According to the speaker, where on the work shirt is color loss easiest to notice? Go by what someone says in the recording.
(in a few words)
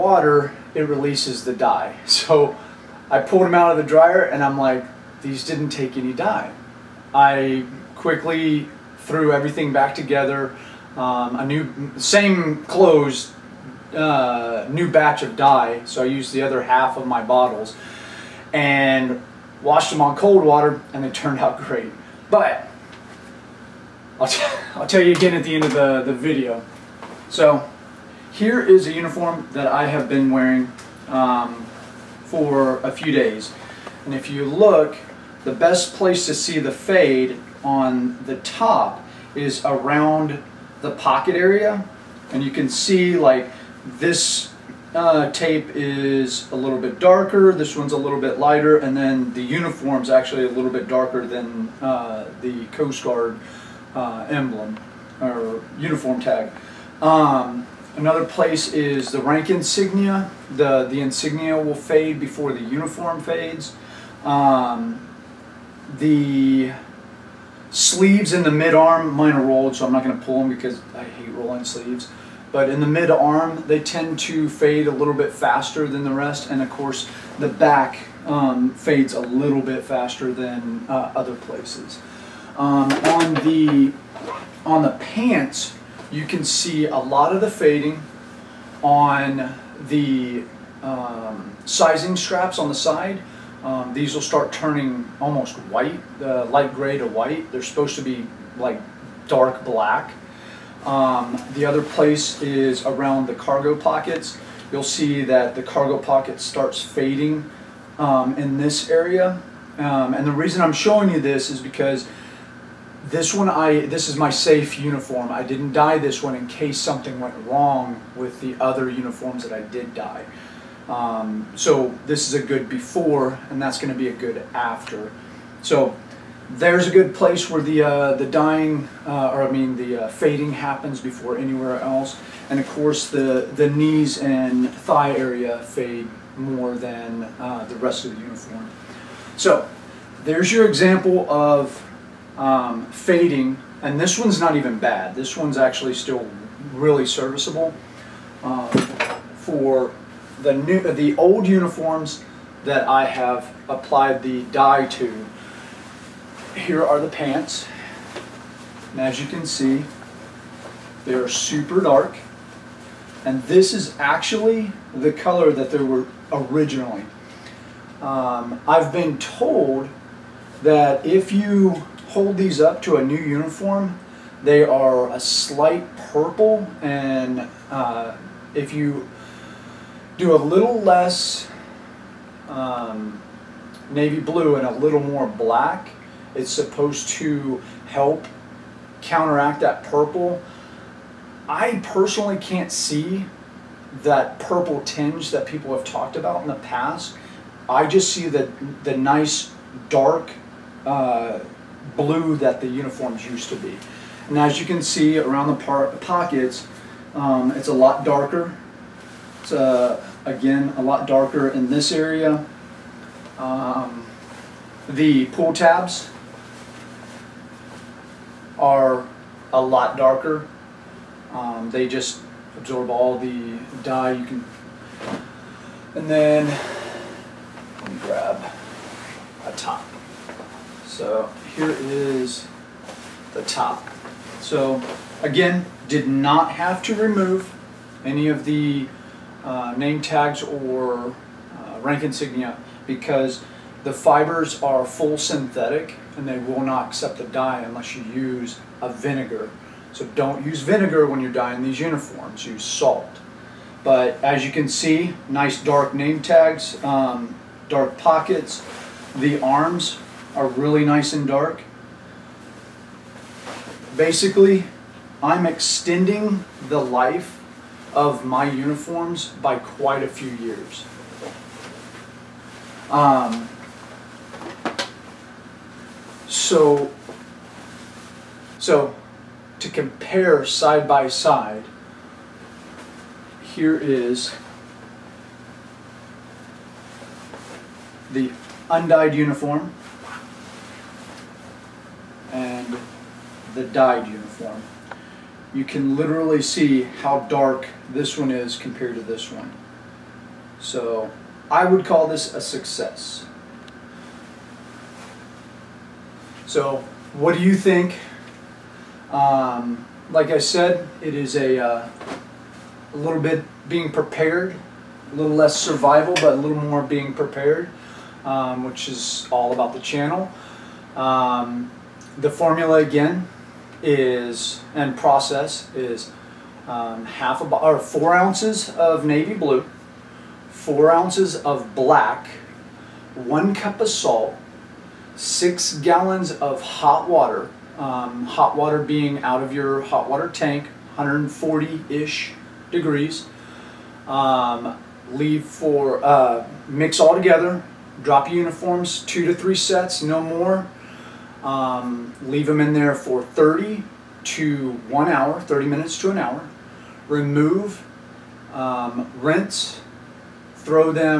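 Around the pocket.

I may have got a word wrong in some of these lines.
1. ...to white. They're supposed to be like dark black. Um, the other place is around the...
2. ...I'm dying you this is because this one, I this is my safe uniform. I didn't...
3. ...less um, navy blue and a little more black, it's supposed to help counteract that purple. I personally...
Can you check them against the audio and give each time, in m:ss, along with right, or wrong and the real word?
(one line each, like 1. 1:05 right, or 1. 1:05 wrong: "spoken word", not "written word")
1. 1:36 right
2. 1:50 wrong: "showing", not "dying"
3. 3:00 right.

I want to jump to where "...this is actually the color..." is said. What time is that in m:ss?
2:43.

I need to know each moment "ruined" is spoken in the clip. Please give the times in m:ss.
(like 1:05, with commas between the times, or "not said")
not said.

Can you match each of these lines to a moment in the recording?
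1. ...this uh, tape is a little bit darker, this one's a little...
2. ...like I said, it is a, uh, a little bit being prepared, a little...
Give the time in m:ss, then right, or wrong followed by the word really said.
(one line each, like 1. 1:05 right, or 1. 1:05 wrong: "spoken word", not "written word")
1. 0:43 right
2. 5:10 right.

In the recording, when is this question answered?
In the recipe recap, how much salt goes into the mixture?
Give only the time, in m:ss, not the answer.
5:33.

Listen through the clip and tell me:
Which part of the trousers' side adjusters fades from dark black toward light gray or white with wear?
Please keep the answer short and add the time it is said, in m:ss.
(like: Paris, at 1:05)
Sizing straps, at 1:31.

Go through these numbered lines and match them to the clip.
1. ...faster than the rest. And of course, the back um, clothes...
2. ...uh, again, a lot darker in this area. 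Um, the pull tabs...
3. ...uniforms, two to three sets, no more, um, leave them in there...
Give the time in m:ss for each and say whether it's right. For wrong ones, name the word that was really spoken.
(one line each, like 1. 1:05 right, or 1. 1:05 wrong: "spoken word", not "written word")
1. 1:15 wrong: "fades", not "clothes"
2. 3:29 right
3. 5:48 right.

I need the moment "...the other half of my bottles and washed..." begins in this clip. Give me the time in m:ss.
0:16.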